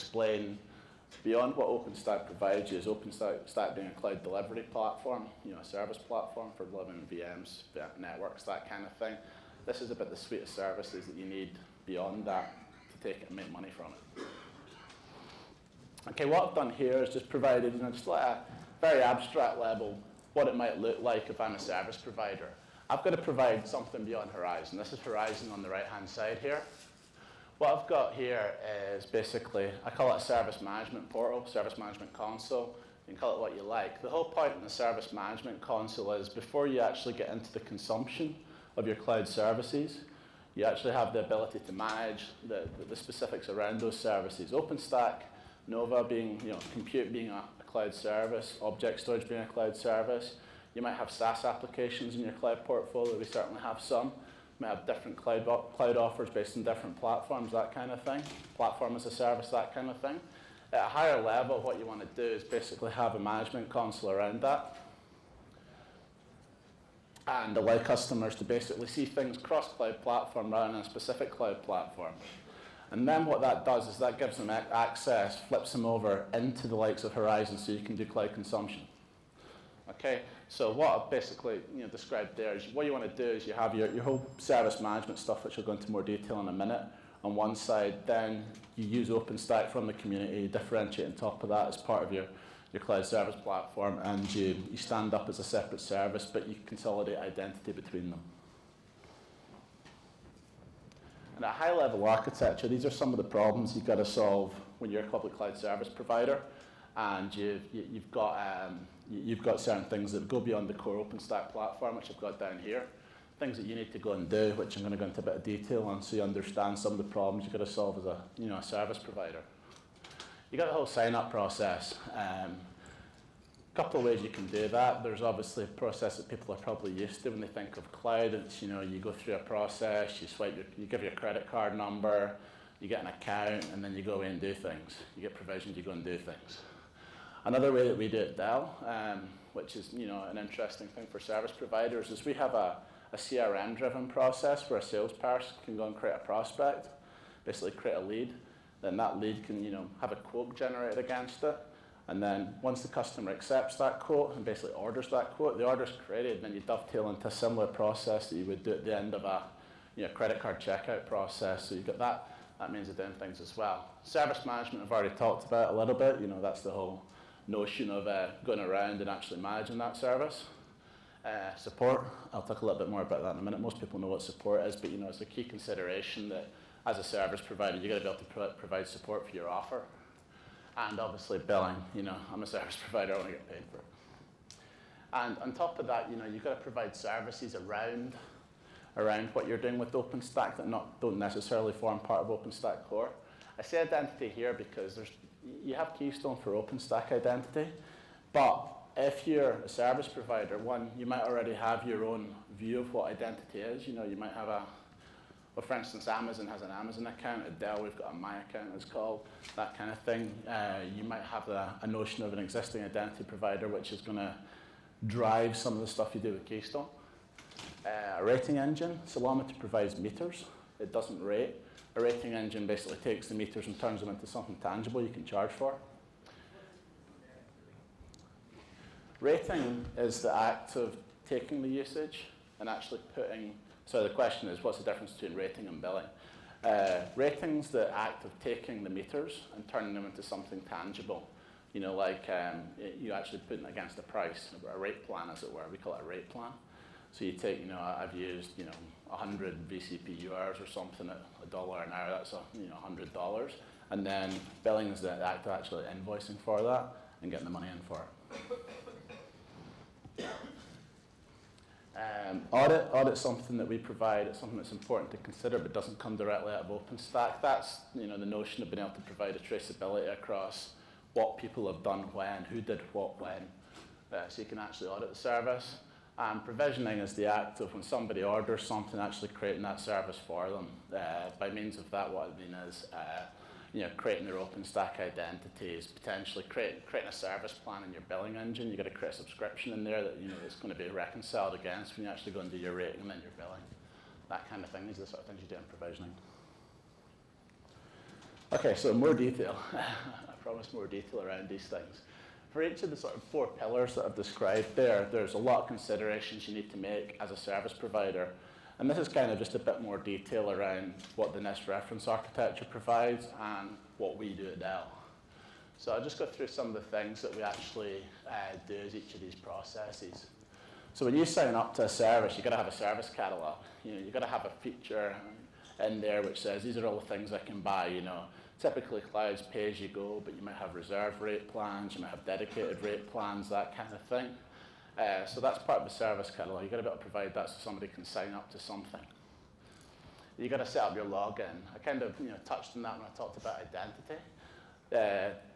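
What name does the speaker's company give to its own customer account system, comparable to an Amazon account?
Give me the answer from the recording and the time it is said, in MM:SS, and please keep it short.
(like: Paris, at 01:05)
My account, at 03:28.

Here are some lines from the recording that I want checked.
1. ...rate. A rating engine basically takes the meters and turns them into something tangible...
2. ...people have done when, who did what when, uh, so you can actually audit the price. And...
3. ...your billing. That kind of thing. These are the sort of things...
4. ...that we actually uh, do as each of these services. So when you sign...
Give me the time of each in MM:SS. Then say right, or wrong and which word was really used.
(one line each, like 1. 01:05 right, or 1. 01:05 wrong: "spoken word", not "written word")
1. 03:41 right
2. 04:31 wrong: "service", not "price"
3. 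04:53 right
4. 05:17 wrong: "processes", not "services".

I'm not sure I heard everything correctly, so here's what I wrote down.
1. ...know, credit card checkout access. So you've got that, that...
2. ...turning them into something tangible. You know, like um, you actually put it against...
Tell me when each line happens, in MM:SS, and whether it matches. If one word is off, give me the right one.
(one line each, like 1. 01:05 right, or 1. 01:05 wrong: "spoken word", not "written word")
1. 02:40 wrong: "process", not "access"
2. 03:59 right.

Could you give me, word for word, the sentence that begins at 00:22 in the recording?
I've got to provide something beyond Horizon.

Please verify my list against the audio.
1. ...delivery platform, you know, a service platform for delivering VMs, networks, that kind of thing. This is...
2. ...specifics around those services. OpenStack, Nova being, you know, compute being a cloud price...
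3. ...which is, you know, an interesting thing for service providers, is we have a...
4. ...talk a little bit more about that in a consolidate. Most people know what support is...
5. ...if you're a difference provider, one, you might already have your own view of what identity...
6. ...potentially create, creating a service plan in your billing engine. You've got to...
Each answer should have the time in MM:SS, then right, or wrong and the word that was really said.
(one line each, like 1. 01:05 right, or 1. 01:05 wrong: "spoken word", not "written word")
1. 00:04 right
2. 00:42 wrong: "service", not "price"
3. 02:19 right
4. 02:52 wrong: "minute", not "consolidate"
5. 03:18 wrong: "service", not "difference"
6. 04:45 right.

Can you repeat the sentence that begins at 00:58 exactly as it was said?
Platform as a service, that kind of thing.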